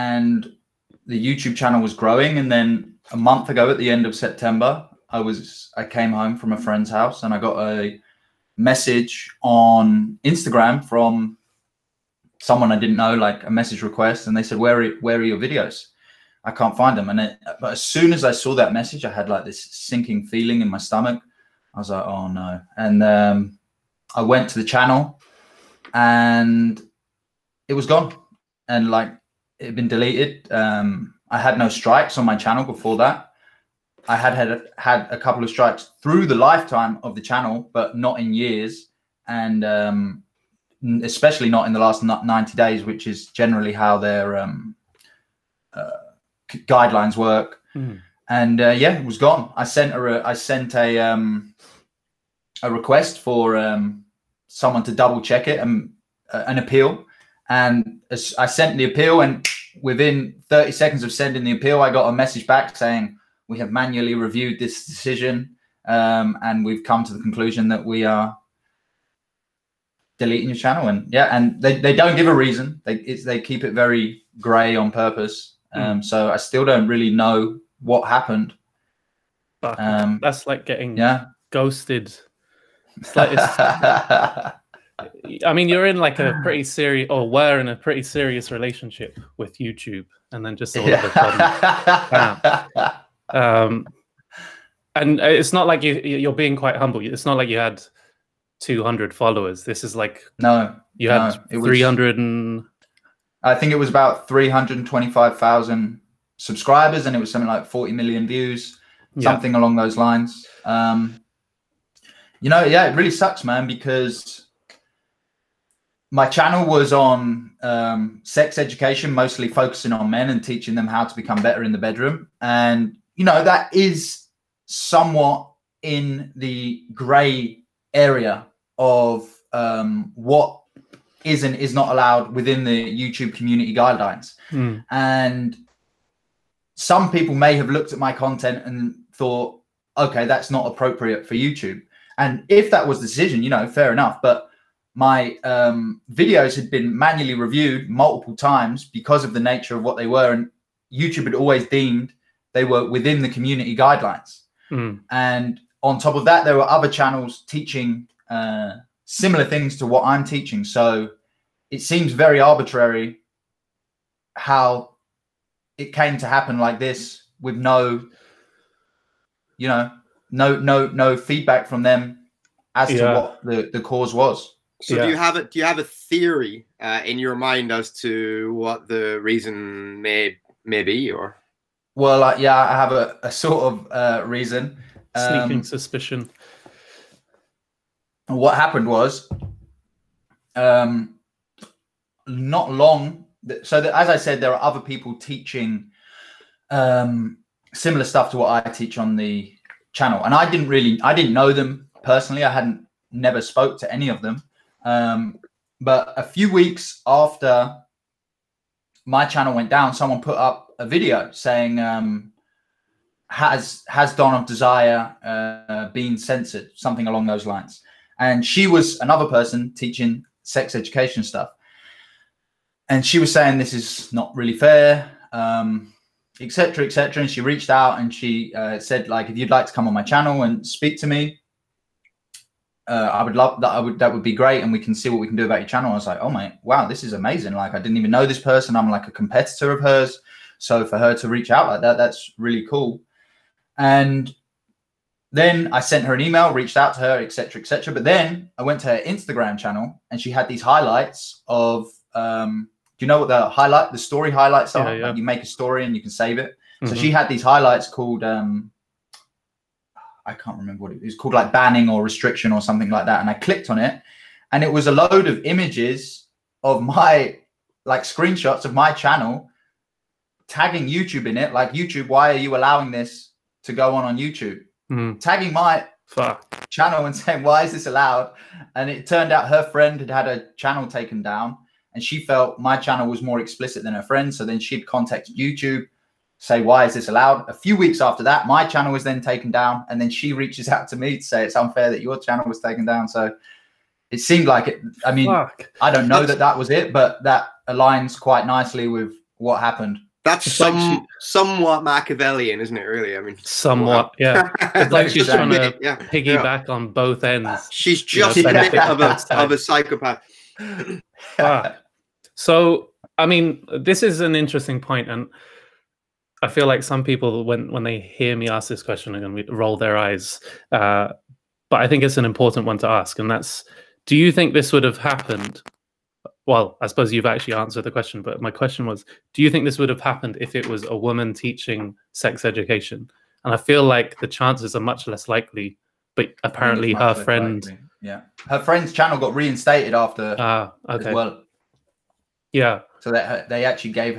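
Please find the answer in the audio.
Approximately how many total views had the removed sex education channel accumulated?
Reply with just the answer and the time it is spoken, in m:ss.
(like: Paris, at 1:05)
40 million, at 1:47.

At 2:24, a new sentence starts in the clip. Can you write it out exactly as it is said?
But my um, videos had been manually reviewed multiple times because of the nature of what they were.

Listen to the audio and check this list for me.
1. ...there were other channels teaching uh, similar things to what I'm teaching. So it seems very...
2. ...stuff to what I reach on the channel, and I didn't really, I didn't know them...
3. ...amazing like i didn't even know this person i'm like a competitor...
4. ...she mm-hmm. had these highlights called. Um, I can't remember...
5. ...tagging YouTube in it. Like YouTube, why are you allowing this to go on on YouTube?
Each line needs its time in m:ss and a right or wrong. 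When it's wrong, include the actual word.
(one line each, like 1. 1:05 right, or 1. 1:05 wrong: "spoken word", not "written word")
1. 2:36 right
2. 3:18 wrong: "teach", not "reach"
3. 3:57 right
4. 4:16 right
5. 4:30 right.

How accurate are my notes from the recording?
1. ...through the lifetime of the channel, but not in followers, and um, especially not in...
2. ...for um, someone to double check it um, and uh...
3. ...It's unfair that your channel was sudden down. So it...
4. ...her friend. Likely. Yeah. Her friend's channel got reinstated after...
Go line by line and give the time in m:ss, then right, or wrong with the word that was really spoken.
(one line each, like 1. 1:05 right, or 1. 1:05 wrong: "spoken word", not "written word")
1. 0:36 wrong: "years", not "followers"
2. 0:53 right
3. 4:51 wrong: "taken", not "sudden"
4. 5:36 right.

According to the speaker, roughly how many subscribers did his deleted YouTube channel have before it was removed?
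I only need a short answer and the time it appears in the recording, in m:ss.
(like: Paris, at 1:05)
325,000, at 1:44.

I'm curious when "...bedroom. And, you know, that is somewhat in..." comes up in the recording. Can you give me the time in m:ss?
2:01.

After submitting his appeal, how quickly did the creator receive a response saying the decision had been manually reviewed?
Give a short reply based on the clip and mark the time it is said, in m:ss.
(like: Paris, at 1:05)
30 seconds, at 1:00.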